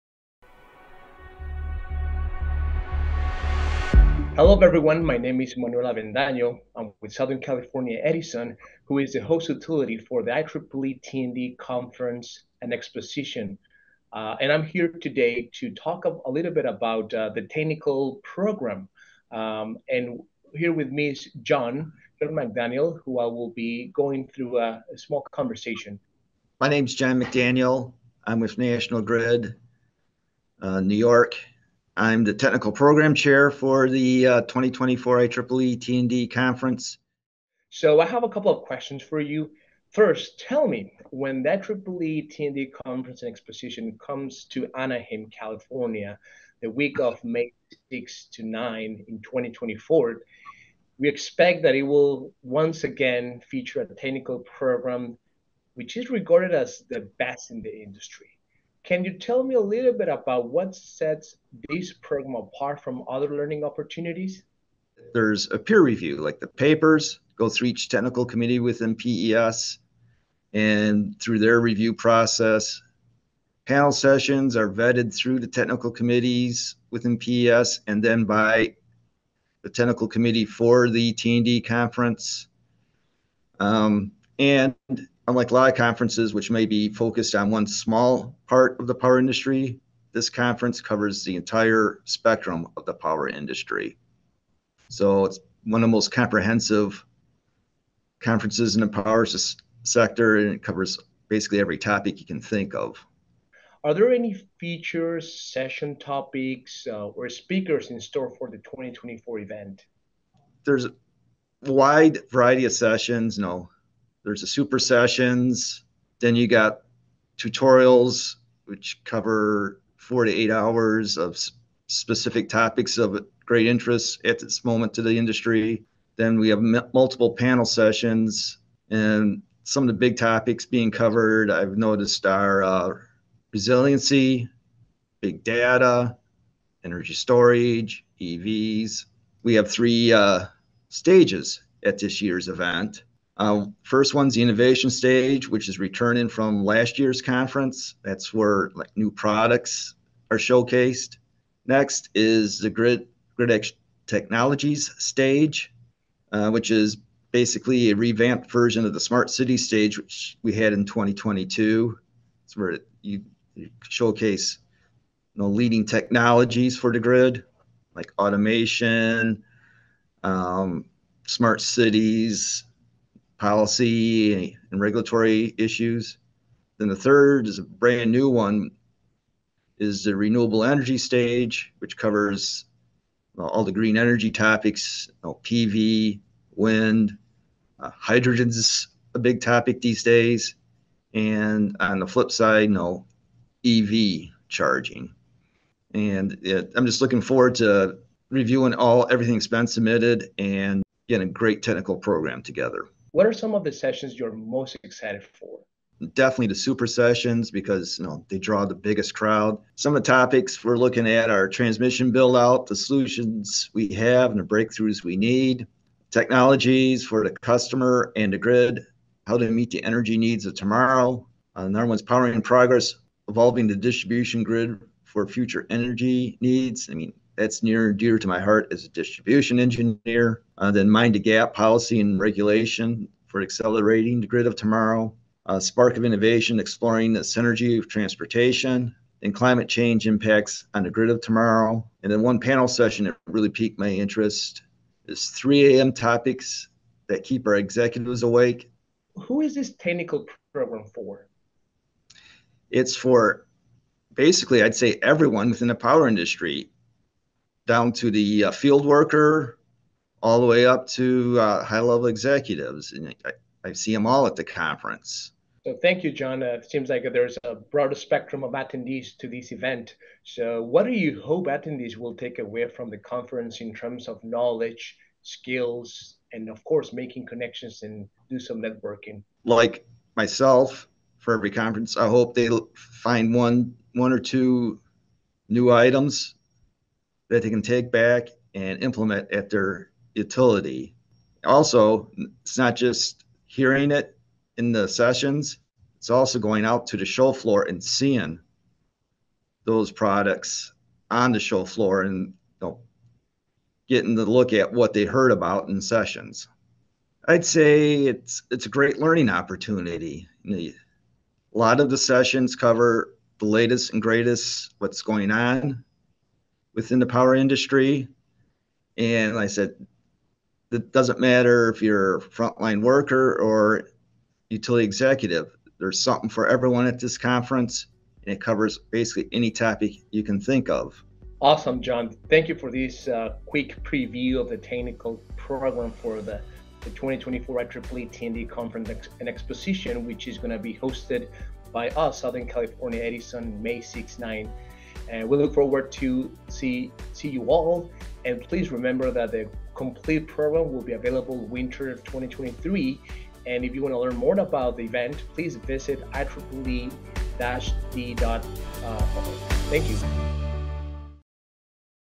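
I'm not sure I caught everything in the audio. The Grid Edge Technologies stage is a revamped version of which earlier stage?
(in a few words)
smart city stage.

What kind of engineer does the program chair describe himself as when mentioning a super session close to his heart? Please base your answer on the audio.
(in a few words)
distribution engineer.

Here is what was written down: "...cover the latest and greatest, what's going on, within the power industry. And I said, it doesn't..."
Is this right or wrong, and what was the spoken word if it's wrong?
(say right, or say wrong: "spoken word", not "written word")
right.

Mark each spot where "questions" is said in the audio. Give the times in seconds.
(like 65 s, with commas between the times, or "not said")
38 s.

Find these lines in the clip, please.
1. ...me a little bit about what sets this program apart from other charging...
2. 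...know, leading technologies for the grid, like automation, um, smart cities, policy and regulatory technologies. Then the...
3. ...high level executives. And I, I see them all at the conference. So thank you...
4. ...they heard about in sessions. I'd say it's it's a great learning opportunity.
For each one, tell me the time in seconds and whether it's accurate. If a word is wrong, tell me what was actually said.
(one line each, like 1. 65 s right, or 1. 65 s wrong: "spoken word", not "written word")
1. 59 s wrong: "learning", not "charging"
2. 165 s wrong: "issues", not "technologies"
3. 261 s right
4. 304 s right.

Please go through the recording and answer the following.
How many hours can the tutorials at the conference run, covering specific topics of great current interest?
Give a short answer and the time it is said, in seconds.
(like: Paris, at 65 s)
4 to 8 hours, at 119 s.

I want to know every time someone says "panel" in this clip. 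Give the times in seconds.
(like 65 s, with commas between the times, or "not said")
73 s, 127 s, 242 s.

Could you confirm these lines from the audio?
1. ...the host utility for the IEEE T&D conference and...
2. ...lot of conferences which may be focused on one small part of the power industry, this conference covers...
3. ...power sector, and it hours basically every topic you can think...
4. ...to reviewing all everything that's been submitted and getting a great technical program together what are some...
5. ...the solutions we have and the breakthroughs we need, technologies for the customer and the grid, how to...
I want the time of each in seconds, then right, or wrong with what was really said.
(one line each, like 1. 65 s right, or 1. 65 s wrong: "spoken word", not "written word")
1. 9 s right
2. 85 s right
3. 98 s wrong: "covers", not "hours"
4. 197 s right
5. 212 s right.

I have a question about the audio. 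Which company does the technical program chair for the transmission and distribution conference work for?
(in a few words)
National Grid.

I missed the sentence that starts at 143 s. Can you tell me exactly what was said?
Uh, first one's the innovation stage, which is returning from last year's conference.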